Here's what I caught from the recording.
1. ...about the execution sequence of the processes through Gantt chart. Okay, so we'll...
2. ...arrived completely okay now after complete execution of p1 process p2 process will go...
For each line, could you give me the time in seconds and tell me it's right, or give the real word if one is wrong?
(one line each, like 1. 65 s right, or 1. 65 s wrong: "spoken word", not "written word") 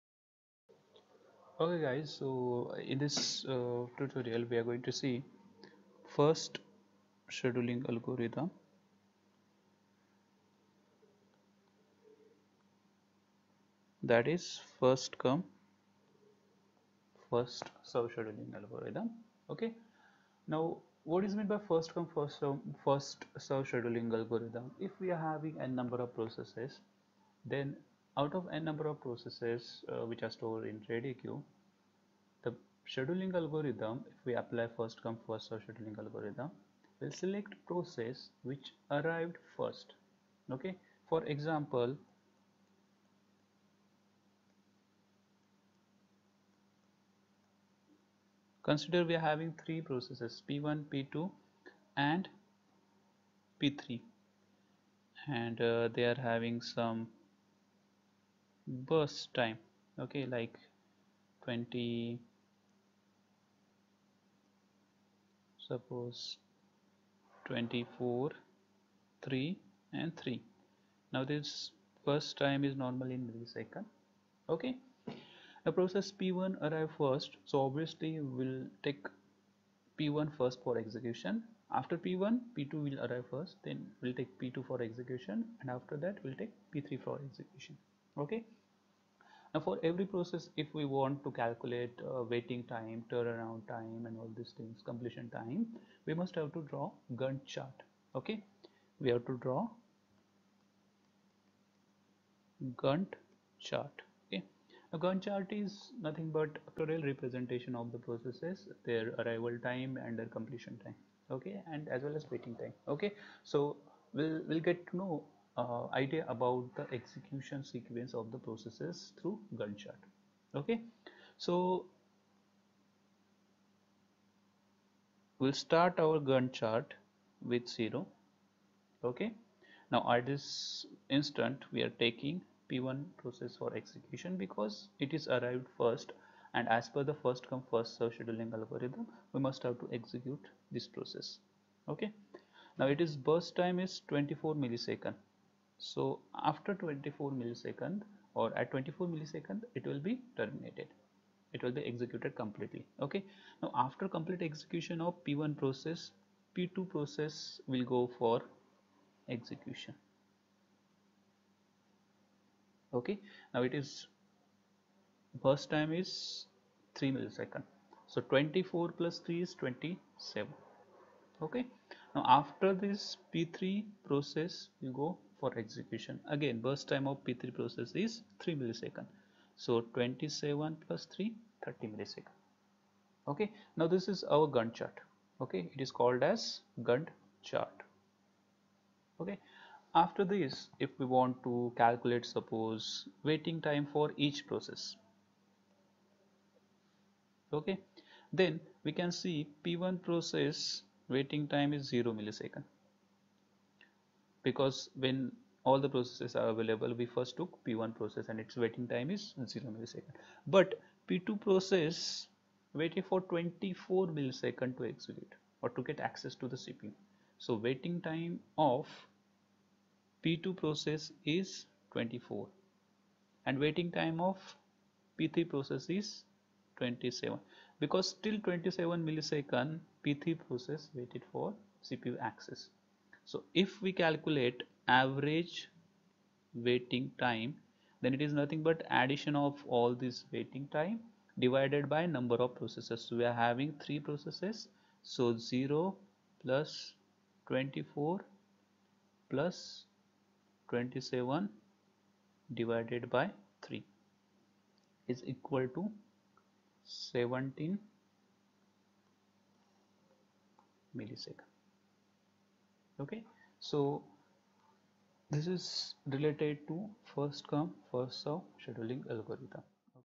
1. 116 s right
2. 151 s wrong: "executed", not "arrived".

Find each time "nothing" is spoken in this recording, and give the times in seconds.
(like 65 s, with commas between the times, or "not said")
106 s, 238 s.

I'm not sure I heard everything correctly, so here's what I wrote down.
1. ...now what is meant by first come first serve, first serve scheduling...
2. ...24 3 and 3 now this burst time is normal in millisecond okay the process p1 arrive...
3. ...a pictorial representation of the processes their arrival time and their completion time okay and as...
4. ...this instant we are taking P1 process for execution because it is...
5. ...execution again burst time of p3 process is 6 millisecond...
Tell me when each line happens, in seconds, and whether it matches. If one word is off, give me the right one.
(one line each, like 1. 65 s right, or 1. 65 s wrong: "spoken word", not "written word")
1. 20 s right
2. 67 s right
3. 106 s right
4. 130 s right
5. 175 s wrong: "3", not "6".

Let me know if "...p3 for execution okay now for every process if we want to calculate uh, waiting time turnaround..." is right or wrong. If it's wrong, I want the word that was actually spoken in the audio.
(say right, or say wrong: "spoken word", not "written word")
right.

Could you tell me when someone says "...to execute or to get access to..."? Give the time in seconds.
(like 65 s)
214 s.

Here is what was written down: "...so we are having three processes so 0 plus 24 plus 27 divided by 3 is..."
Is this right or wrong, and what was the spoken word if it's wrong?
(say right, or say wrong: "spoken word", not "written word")
right.